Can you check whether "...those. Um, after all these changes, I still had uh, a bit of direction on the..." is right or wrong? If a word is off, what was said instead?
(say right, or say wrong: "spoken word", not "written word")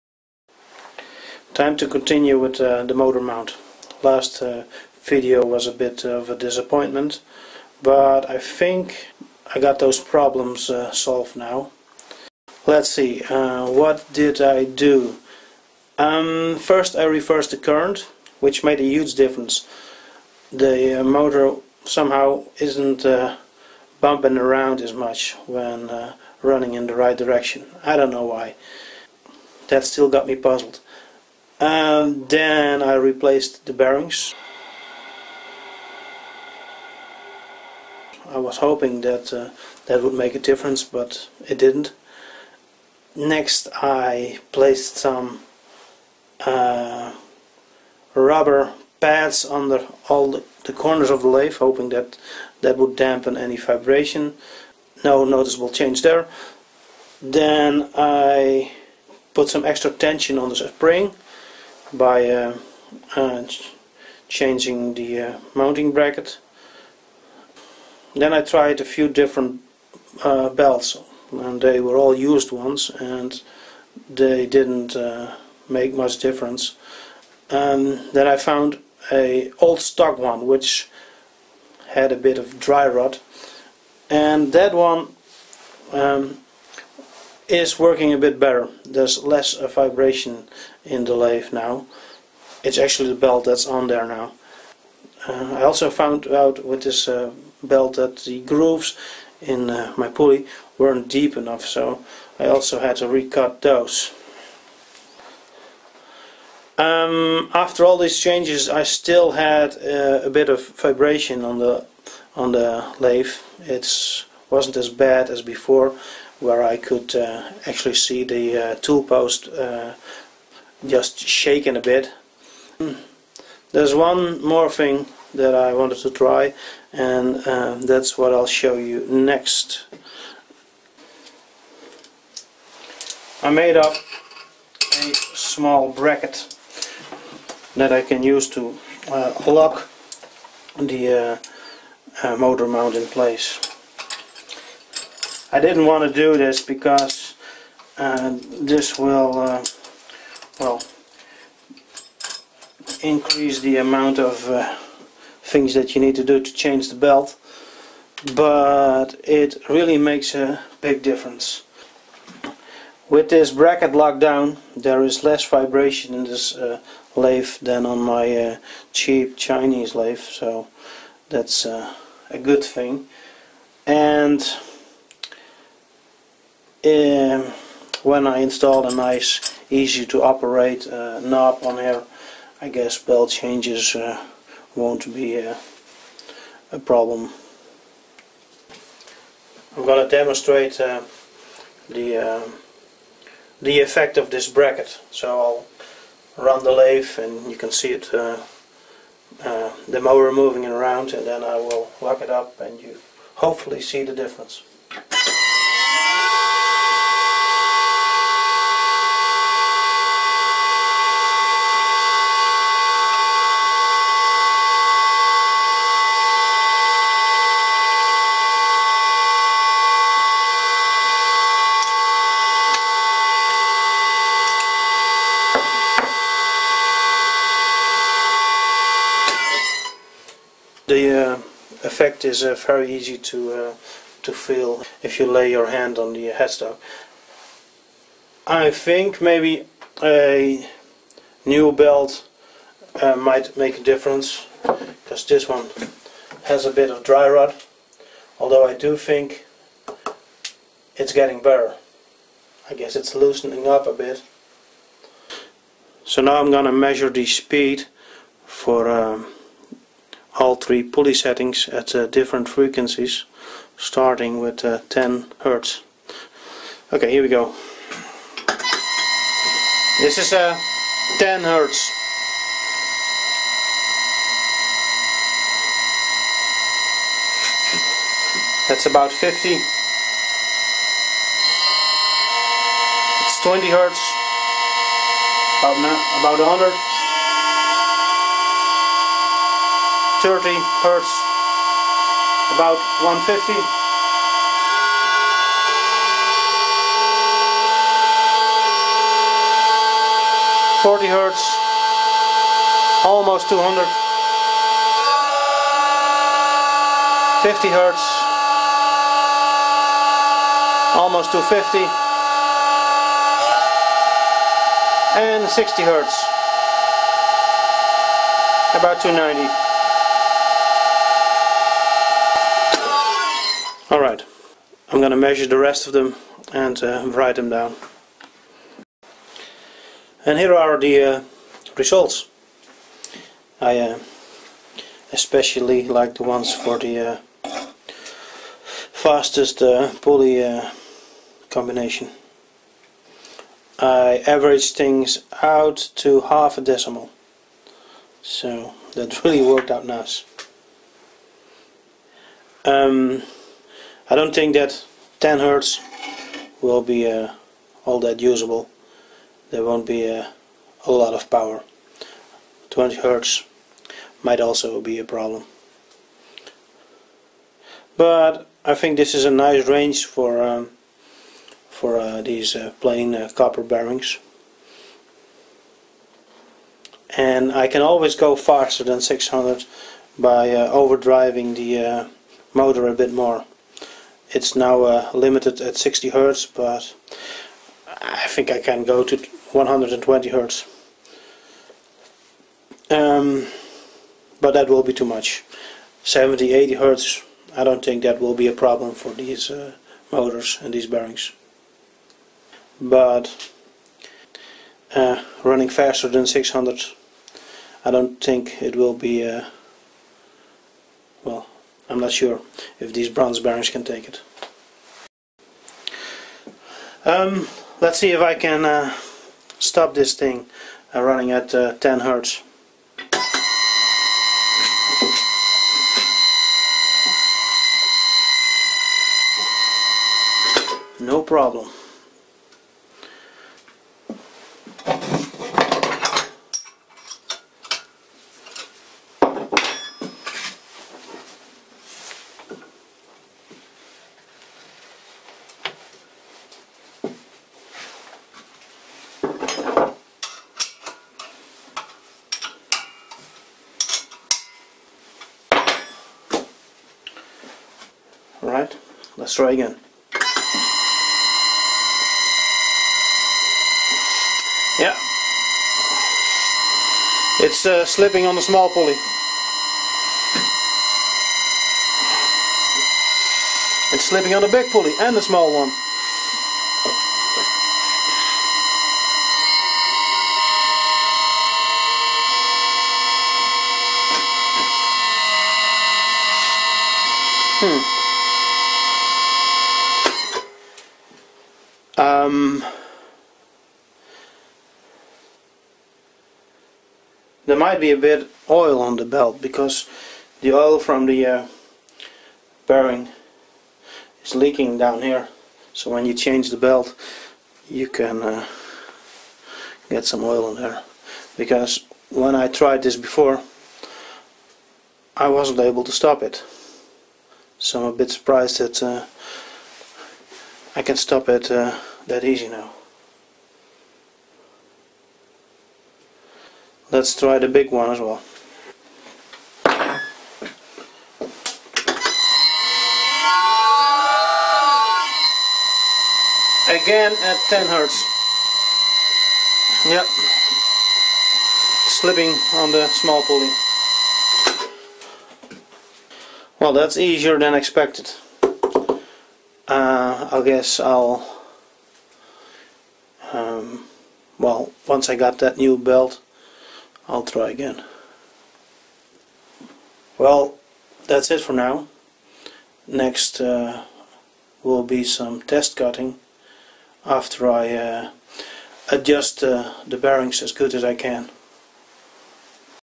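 wrong: "vibration", not "direction".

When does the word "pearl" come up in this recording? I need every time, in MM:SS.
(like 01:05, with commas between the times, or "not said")
not said.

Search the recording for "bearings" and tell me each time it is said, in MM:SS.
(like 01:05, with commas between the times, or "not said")
00:33, 06:13, 06:40, 06:53, 08:22, 09:29.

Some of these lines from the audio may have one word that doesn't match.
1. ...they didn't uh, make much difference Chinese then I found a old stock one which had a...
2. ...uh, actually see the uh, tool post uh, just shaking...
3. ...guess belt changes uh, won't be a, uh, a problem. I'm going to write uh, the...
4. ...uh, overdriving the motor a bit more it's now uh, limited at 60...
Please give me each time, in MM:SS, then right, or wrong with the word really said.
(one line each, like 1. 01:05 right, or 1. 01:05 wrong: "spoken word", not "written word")
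1. 01:14 wrong: "And", not "Chinese"
2. 01:57 right
3. 03:02 wrong: "demonstrate", not "write"
4. 06:20 right.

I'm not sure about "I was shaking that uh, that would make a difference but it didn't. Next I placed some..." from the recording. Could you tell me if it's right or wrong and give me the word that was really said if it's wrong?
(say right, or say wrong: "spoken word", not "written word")
wrong: "hoping", not "shaking".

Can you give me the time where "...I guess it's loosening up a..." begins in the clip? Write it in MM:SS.
04:12.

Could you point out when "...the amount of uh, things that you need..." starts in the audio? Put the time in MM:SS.
02:33.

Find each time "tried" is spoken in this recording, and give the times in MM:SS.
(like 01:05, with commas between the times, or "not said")
01:08, 08:32.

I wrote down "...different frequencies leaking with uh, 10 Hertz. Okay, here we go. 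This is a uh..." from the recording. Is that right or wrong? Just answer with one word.
wrong.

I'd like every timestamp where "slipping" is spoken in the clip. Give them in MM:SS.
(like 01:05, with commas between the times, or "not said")
07:47, 07:54, 09:01.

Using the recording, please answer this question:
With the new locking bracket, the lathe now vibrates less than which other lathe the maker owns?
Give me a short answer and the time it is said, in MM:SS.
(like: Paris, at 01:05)
Cheap Chinese lathe, at 02:48.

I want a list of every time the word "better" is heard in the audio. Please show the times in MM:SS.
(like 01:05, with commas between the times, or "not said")
01:28, 04:11.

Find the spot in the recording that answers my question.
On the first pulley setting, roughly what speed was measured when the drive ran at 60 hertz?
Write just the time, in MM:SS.
05:18.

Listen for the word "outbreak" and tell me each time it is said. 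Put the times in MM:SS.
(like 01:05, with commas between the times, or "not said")
not said.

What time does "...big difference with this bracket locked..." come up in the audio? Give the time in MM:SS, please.
02:40.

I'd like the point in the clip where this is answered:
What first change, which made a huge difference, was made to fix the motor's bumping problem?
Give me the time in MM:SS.
00:17.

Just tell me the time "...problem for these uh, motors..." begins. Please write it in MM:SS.
06:38.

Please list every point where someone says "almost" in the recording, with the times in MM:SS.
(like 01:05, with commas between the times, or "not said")
05:03, 05:11.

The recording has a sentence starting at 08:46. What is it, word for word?
Let's try the big one as well.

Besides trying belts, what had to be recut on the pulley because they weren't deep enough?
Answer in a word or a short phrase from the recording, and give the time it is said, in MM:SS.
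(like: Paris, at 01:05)
The grooves, at 01:38.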